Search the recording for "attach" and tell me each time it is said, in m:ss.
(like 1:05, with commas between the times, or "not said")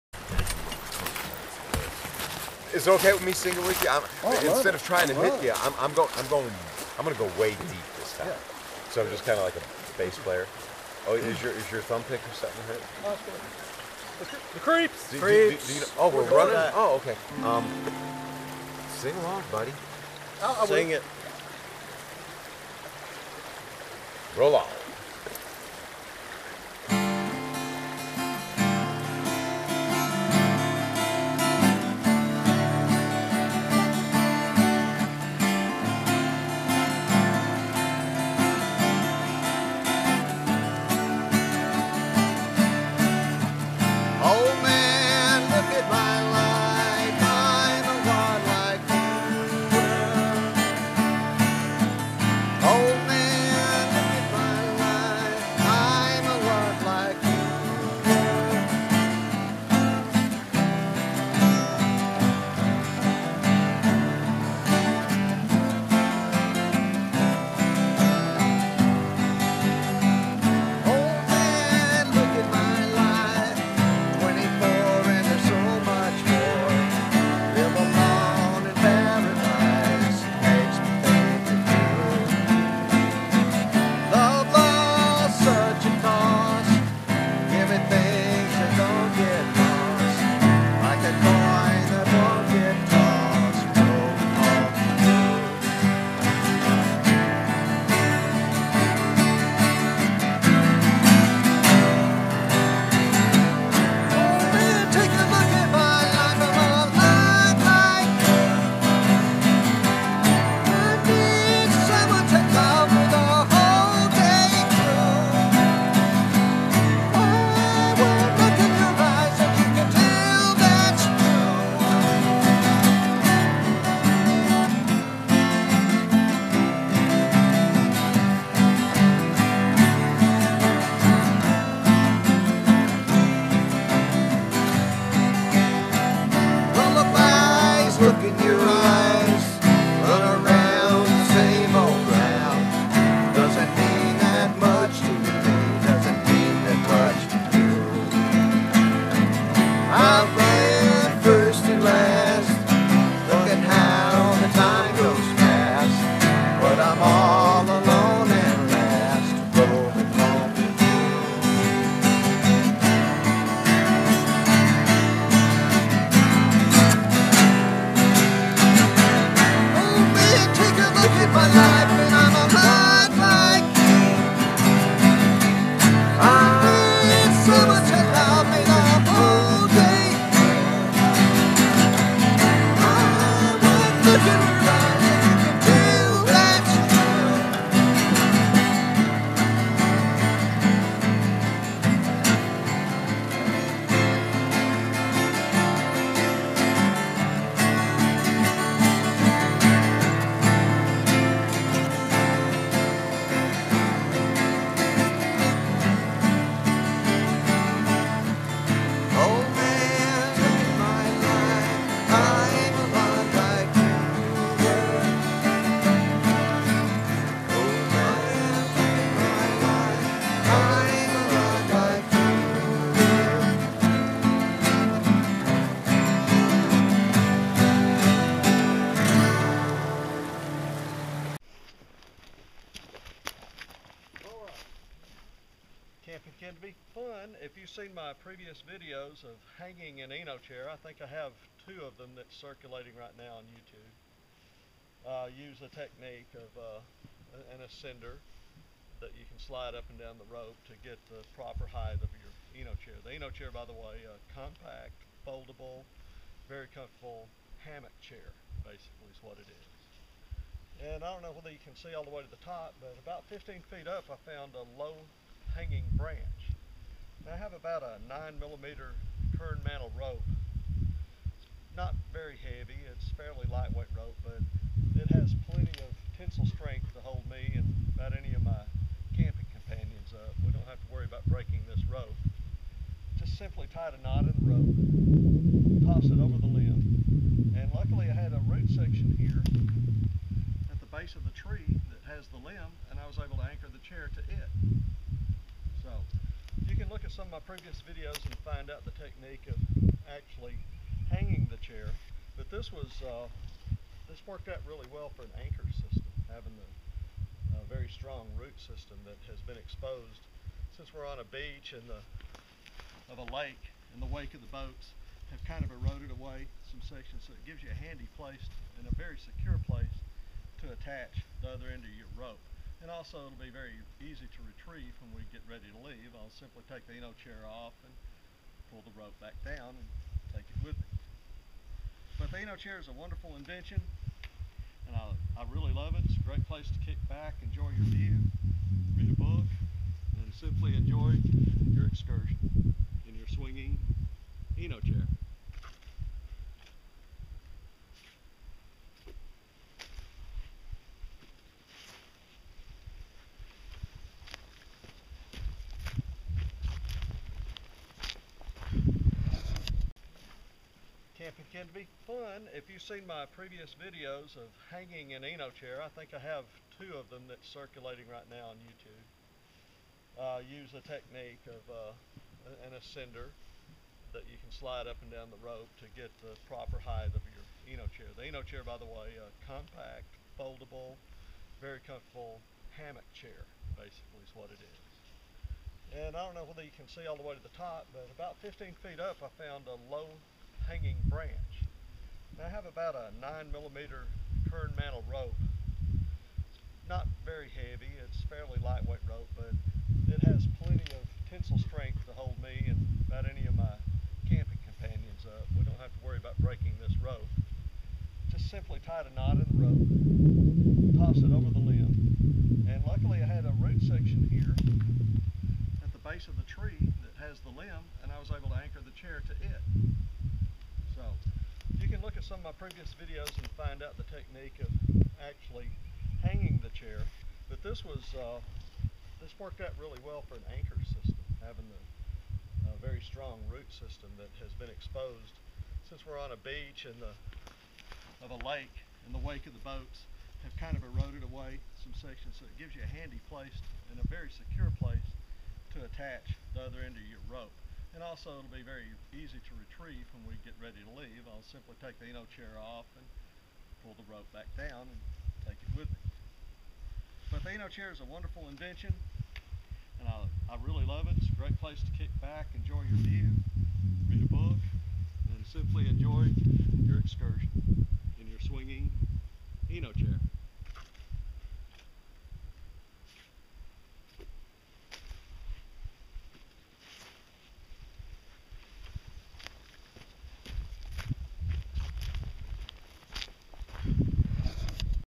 5:20, 7:25.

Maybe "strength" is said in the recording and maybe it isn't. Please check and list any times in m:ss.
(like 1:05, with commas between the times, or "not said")
4:36, 6:41.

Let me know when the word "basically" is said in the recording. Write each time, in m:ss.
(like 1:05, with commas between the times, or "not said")
4:18, 6:23.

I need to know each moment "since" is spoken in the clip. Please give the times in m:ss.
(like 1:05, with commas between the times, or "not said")
5:10, 7:15.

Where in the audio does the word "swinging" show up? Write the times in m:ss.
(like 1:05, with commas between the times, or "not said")
5:43, 7:48.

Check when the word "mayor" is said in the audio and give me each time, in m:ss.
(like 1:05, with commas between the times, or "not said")
not said.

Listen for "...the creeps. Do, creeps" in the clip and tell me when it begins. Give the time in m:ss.
0:14.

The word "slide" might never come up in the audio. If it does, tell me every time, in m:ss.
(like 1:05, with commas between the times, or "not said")
4:09, 6:14.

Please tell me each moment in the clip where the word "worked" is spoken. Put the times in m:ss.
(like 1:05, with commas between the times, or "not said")
5:04, 7:09.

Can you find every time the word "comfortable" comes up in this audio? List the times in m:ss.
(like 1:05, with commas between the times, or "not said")
4:16, 6:21.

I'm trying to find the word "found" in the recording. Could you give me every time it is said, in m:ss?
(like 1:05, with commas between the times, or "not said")
4:24, 6:29.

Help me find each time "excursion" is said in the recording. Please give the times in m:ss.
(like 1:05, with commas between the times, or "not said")
5:41, 7:46.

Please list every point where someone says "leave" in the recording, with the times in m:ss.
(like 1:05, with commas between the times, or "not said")
5:25, 7:30.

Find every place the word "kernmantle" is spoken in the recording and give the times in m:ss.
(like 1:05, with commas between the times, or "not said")
4:29, 6:34.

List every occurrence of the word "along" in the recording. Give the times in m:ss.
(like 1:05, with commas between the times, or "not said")
0:19.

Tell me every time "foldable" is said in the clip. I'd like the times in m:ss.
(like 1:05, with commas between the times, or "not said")
4:15, 6:20.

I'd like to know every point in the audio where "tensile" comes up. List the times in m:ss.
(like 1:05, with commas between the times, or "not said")
4:36, 6:41.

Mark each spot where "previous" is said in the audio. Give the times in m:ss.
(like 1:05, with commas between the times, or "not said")
3:58, 4:57, 6:03, 7:02.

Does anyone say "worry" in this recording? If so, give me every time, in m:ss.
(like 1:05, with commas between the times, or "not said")
4:40, 6:46.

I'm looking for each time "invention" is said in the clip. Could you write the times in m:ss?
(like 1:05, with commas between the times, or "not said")
5:33, 7:38.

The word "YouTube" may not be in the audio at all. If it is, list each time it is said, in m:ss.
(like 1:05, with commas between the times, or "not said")
4:03, 6:08.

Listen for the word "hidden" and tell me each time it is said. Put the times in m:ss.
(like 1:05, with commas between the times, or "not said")
not said.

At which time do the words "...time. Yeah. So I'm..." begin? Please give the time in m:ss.
0:08.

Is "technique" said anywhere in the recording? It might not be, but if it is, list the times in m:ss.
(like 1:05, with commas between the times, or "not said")
4:05, 4:58, 6:10, 7:04.